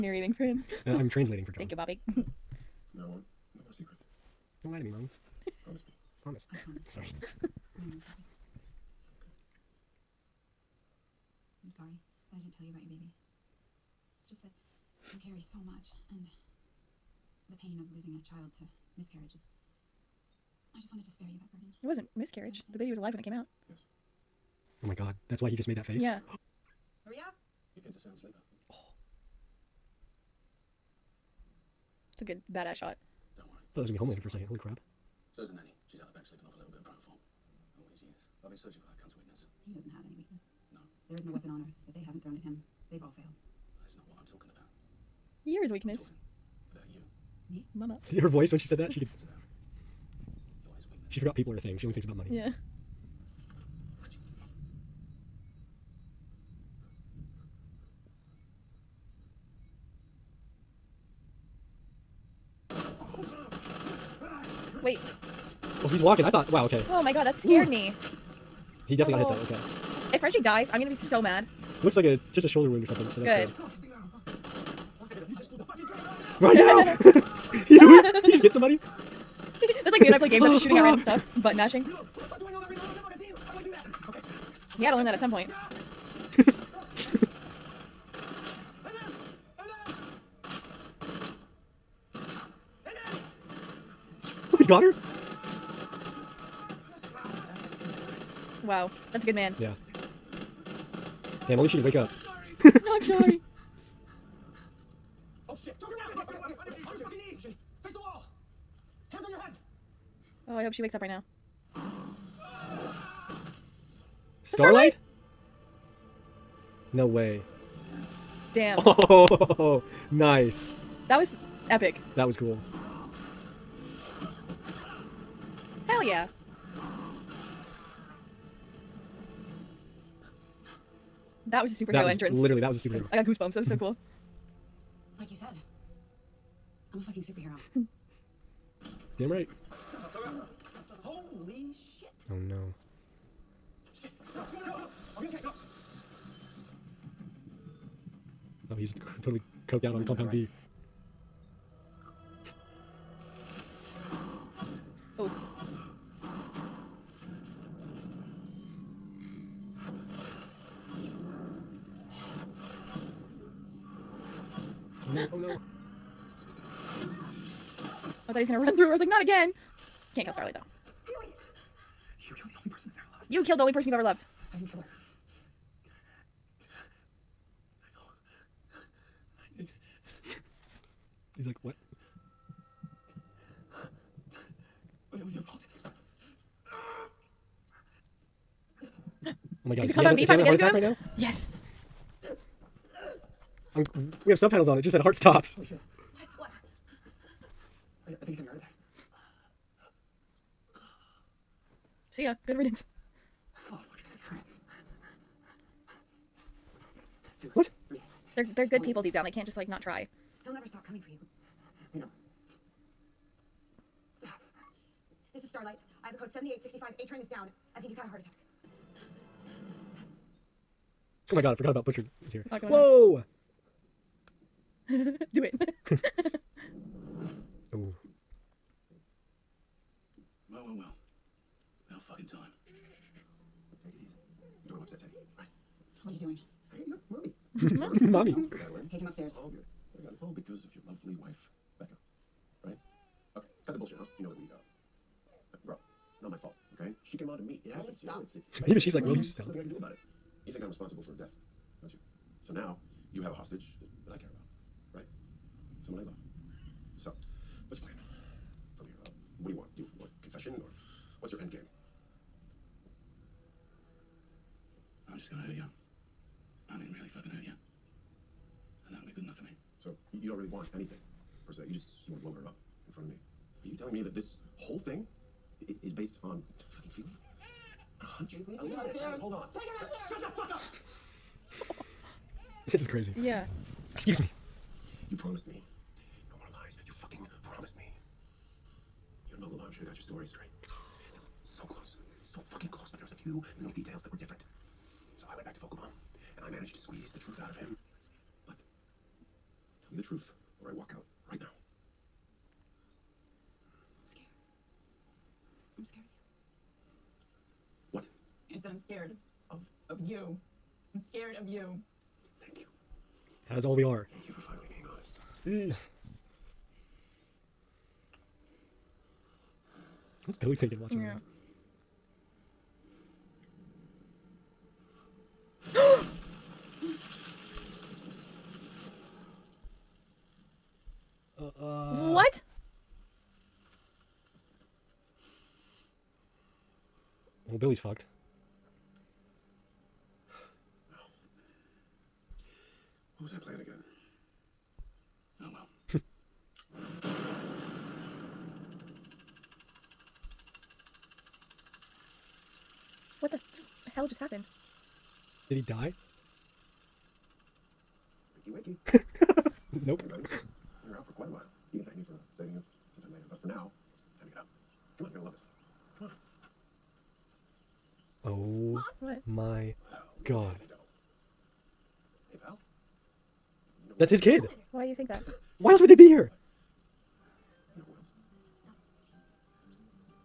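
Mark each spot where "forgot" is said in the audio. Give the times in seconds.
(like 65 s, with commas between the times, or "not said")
51 s, 221 s.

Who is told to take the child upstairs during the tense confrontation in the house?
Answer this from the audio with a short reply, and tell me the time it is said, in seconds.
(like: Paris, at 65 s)
Madeline, at 238 s.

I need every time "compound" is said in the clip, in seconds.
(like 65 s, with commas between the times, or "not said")
150 s, 189 s.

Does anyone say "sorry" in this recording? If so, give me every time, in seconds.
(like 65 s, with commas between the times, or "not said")
6 s, 11 s, 103 s.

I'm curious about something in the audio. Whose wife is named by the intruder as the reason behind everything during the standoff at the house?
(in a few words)
Becca.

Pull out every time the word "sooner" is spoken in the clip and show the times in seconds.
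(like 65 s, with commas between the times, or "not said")
not said.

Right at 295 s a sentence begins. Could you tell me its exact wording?
So I went back to Vogelbaum, and I managed to squeeze the truth out of him.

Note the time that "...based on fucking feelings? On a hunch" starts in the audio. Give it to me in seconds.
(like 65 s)
275 s.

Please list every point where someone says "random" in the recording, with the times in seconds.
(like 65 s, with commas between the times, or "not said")
80 s.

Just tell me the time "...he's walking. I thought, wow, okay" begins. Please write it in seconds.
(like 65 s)
65 s.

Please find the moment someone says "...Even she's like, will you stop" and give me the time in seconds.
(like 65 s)
248 s.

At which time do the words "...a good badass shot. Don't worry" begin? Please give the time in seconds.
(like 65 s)
32 s.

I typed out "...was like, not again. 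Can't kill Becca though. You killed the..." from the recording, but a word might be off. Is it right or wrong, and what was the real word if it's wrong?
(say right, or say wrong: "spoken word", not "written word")
wrong: "Starlight", not "Becca".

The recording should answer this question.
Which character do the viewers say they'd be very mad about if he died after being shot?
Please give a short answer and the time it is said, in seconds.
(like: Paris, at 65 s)
Frenchie, at 70 s.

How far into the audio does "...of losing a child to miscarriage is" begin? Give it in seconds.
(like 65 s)
17 s.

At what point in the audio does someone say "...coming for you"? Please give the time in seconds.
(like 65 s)
210 s.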